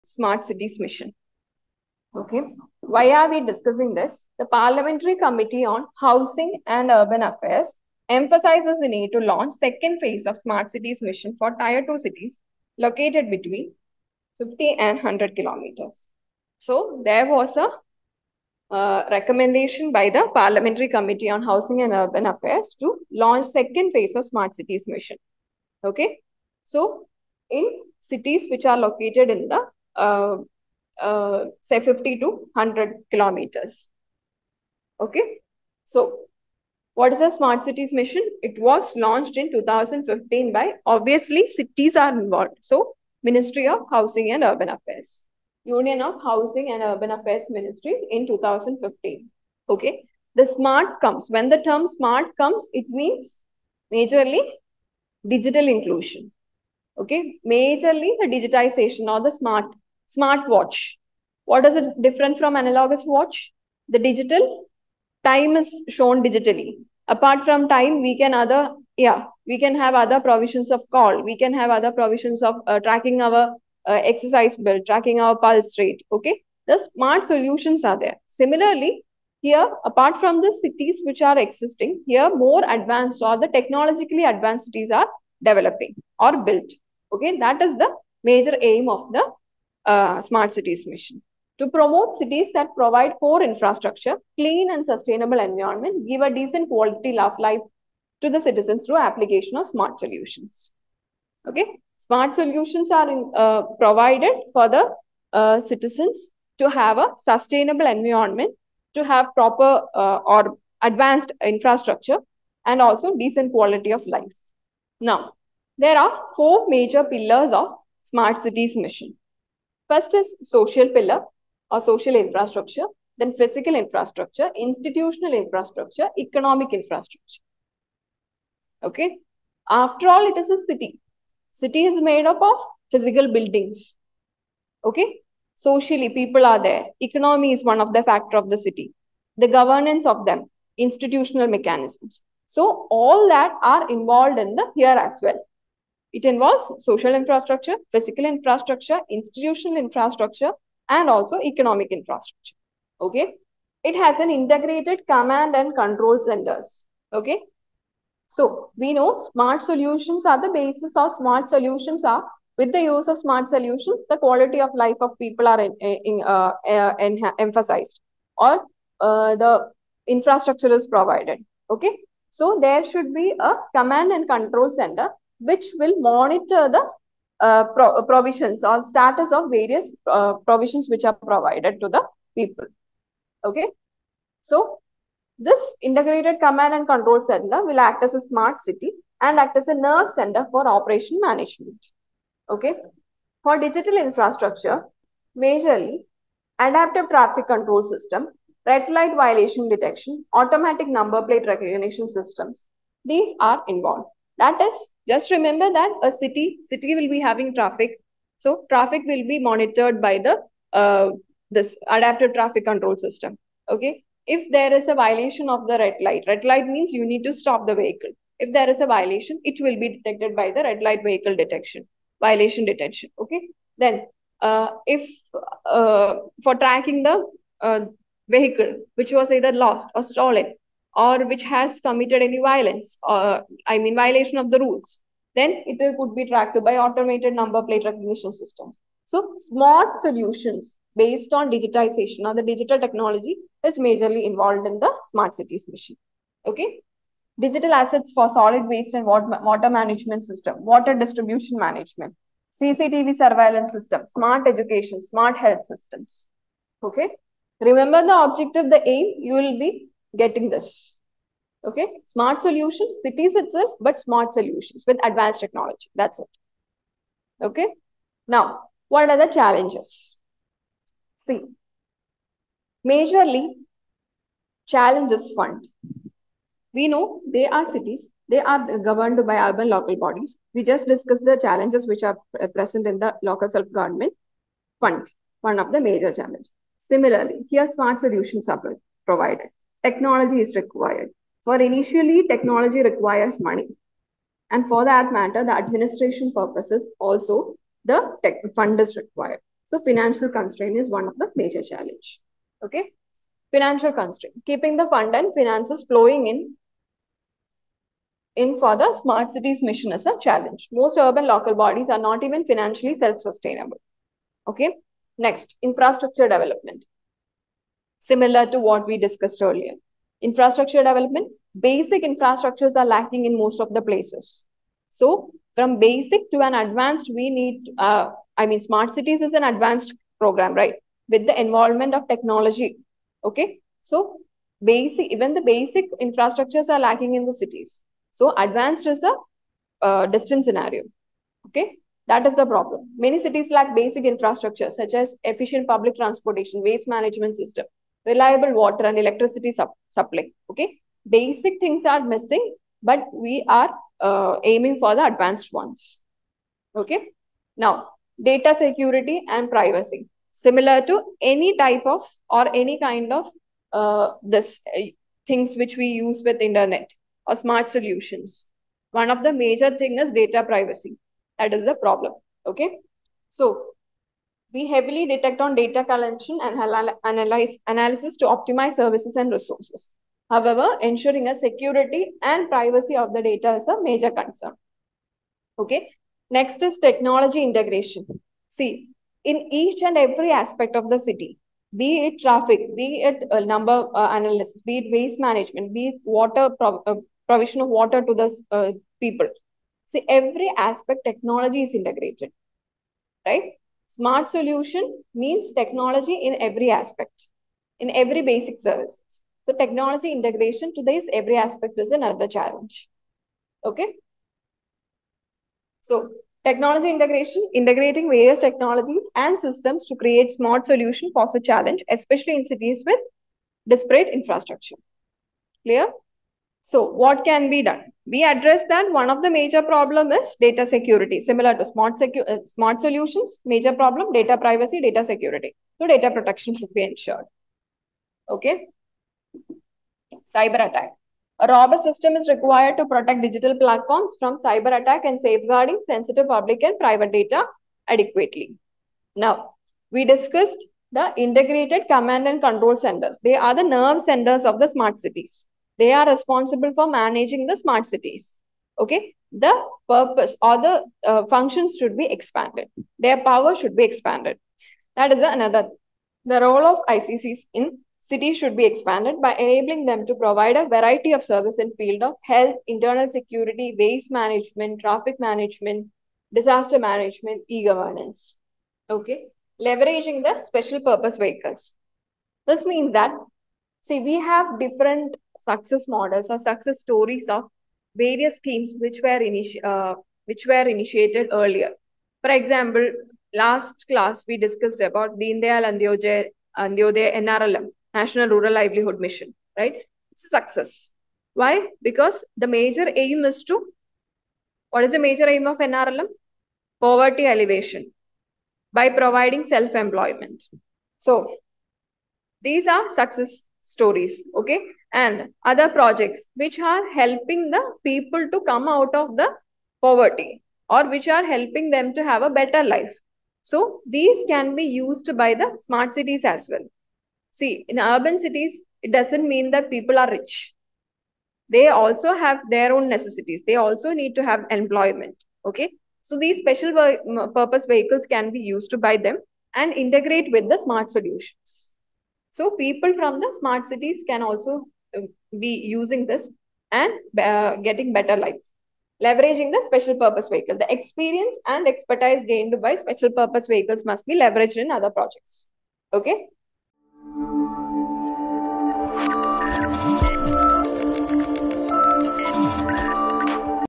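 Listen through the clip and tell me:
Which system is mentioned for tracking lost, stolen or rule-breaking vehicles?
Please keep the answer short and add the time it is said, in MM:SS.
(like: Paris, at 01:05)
Automated number plate recognition systems, at 03:56.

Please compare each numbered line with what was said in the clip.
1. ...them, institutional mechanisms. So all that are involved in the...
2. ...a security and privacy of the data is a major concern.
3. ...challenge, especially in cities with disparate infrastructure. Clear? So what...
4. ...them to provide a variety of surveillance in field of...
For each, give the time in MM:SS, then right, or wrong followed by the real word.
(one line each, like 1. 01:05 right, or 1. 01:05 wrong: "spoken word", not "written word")
1. 02:20 right
2. 06:21 right
3. 07:01 right
4. 07:49 wrong: "service", not "surveillance".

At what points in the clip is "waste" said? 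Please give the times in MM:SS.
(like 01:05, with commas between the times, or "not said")
04:08, 05:46, 06:34, 07:53.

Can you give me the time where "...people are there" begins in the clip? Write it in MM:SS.
02:16.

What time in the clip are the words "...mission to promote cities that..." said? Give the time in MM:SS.
01:30.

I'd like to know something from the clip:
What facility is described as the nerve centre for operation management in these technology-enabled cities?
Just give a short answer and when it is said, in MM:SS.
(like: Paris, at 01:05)
Integrated command and control center, at 03:05.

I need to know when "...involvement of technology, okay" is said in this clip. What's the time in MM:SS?
05:31.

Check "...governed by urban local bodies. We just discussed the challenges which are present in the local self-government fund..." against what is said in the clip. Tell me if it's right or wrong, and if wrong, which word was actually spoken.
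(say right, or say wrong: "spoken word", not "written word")
right.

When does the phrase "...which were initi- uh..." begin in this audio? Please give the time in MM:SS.
08:08.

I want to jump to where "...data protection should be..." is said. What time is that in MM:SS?
07:15.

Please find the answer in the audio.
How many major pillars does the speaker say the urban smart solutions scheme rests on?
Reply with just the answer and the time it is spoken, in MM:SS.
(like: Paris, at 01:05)
4, at 01:56.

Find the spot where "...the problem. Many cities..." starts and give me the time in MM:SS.
05:42.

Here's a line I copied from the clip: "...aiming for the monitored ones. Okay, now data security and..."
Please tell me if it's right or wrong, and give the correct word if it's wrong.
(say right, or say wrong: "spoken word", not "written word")
wrong: "advanced", not "monitored".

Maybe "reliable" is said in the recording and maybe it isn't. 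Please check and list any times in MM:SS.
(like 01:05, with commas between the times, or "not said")
05:48.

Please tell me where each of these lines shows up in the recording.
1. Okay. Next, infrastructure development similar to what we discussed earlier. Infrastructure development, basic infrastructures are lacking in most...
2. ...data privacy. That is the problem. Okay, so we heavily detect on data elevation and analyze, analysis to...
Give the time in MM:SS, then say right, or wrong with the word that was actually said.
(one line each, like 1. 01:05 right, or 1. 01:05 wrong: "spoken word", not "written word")
1. 05:14 right
2. 06:10 wrong: "collection", not "elevation".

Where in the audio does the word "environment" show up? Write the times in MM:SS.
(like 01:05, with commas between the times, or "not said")
01:35, 01:47.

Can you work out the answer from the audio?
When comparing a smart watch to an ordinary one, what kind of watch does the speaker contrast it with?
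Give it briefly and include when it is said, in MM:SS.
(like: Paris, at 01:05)
Analogous watch, at 01:02.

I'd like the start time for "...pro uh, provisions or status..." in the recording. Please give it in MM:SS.
02:57.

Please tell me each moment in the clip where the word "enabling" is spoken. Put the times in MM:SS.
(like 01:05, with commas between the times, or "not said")
07:49.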